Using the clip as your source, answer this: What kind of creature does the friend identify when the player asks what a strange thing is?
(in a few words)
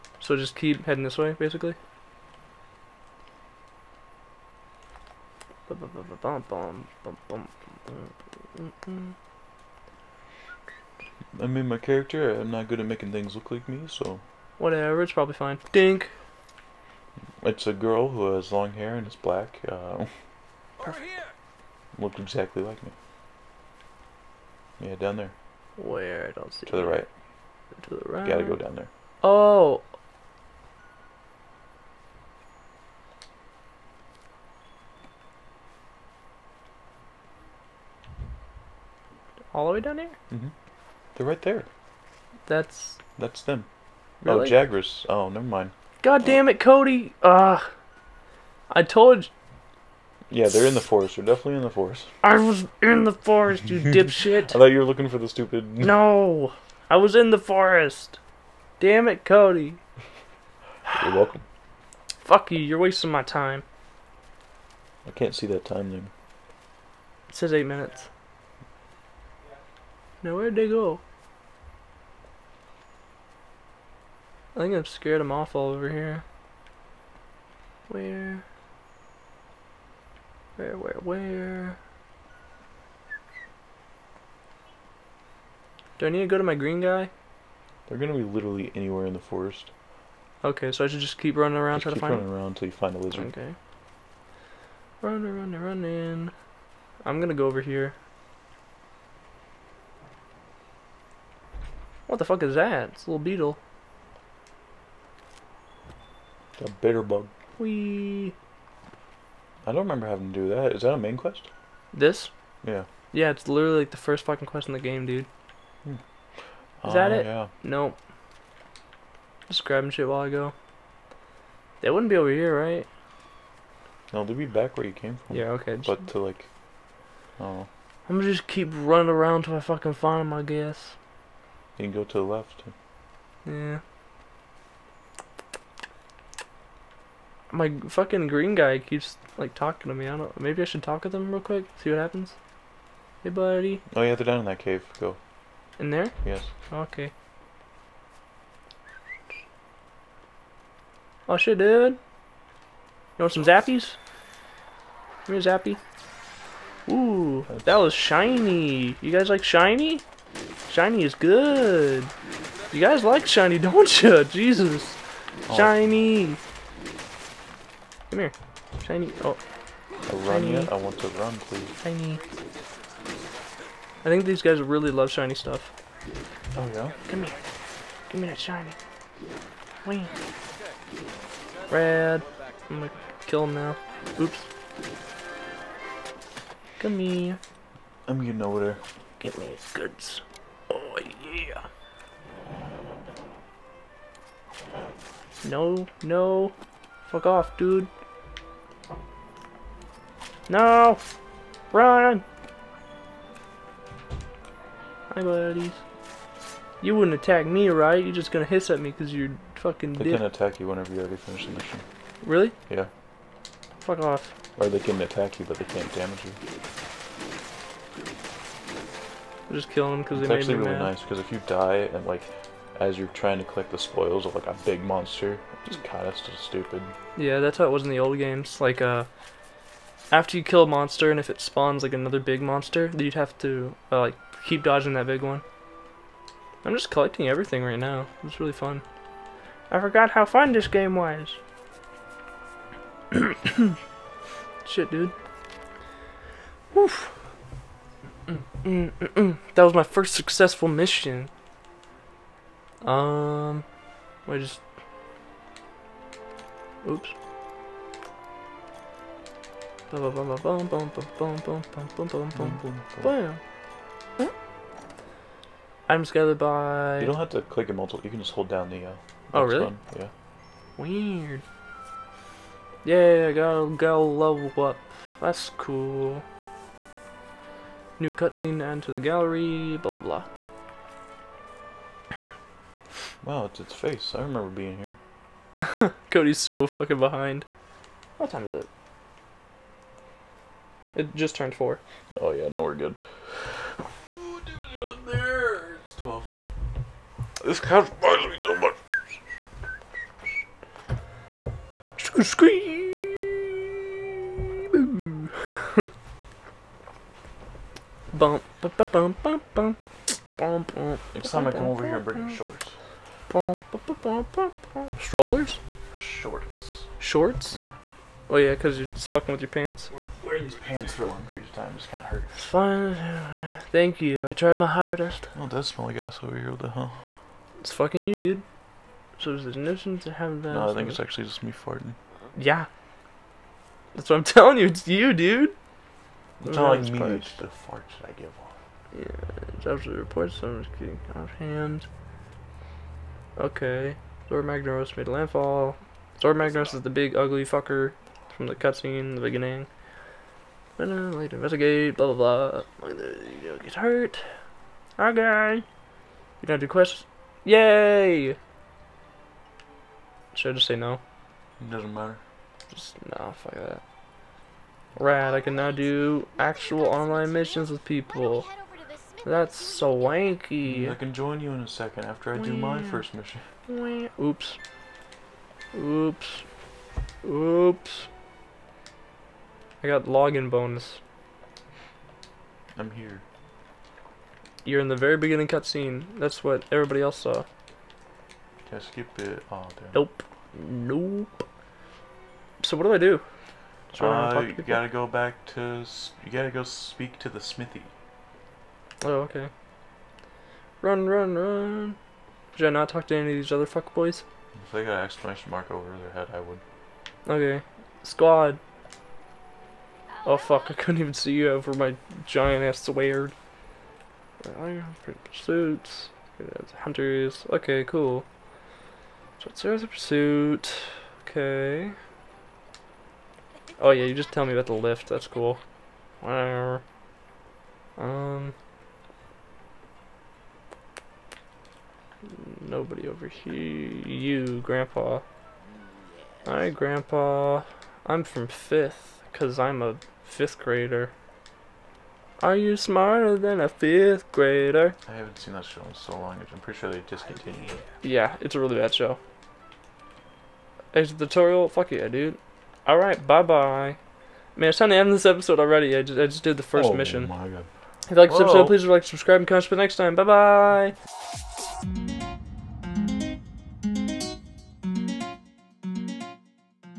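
bitter bug.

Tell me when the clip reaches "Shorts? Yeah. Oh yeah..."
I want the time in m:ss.
5:16.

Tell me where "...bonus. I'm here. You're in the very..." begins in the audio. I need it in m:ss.
6:20.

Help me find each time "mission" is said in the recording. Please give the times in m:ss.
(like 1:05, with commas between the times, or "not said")
3:31, 4:10, 6:07, 6:13, 7:36.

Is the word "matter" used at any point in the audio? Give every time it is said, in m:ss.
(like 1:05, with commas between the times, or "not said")
6:01.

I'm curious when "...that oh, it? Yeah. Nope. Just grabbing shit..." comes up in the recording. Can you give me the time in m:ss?
1:56.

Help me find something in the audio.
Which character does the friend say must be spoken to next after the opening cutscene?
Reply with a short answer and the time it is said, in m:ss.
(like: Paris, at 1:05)
the smithy, at 6:37.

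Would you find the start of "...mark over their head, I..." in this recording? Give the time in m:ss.
6:45.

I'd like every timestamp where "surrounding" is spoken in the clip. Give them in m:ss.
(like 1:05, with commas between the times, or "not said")
not said.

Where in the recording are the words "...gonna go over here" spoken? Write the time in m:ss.
1:37.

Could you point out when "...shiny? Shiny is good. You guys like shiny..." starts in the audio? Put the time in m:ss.
2:39.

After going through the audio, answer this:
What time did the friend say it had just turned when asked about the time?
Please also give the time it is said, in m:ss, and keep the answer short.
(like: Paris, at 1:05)
4, at 4:51.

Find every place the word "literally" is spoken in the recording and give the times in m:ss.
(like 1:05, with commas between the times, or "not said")
1:28, 1:53.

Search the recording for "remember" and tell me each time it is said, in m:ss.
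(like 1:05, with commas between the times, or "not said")
1:49, 4:44.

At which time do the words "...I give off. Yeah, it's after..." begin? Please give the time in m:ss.
5:38.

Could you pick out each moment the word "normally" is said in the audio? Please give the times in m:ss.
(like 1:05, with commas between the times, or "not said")
not said.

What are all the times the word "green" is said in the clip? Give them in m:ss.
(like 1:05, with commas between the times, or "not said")
1:26, 2:18.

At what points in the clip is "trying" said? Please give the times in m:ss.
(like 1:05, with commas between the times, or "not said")
1:31, 3:43.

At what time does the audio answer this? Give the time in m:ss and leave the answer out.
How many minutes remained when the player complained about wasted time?
1:07.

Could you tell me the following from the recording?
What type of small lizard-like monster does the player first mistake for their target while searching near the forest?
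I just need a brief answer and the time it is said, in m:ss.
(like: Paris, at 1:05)
Jagras, at 0:44.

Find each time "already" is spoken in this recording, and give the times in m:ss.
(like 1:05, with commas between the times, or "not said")
3:31, 7:35.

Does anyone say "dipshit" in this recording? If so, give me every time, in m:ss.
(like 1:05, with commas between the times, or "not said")
0:53.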